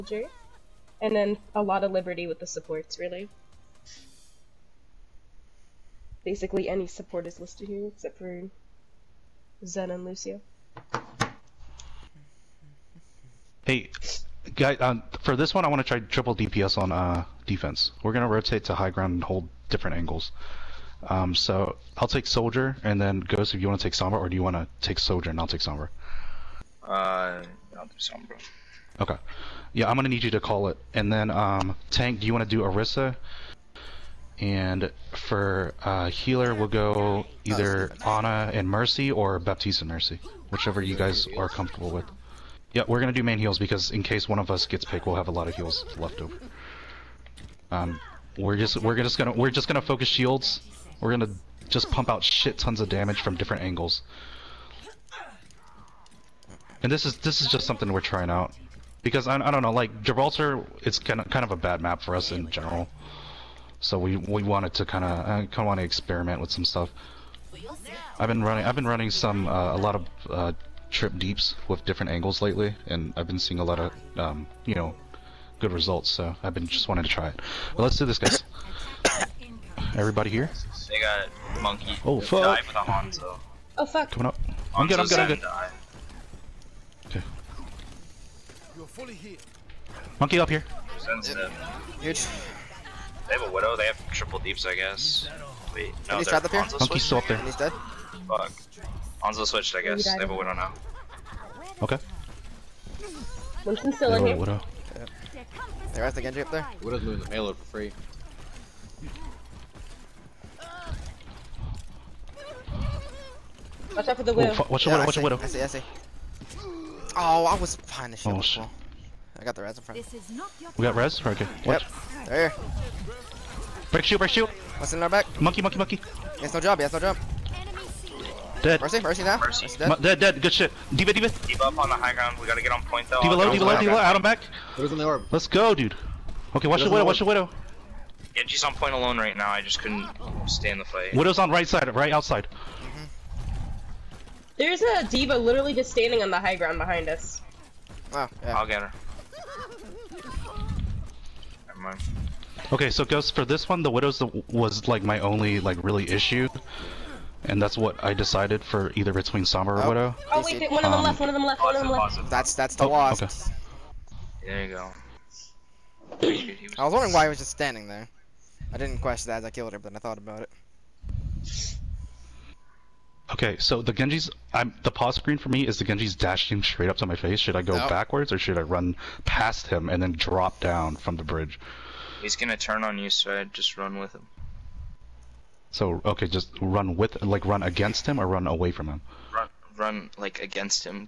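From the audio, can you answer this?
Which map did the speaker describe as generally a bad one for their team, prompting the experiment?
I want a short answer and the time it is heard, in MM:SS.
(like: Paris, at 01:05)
Gibraltar, at 01:00.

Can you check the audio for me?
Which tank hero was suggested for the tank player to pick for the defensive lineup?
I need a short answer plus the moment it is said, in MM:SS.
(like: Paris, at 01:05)
Orisa, at 00:32.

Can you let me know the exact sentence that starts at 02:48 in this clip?
I didn't question that as I killed her, but I thought about it.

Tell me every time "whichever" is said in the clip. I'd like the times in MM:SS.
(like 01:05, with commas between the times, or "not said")
00:40.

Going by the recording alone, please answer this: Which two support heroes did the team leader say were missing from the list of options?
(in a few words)
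Zen and Lucio.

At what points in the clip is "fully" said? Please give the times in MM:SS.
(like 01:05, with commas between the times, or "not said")
01:28.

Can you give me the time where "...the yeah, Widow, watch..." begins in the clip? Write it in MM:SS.
01:54.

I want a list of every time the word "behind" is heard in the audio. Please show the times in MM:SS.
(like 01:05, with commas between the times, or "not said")
01:57, 02:26.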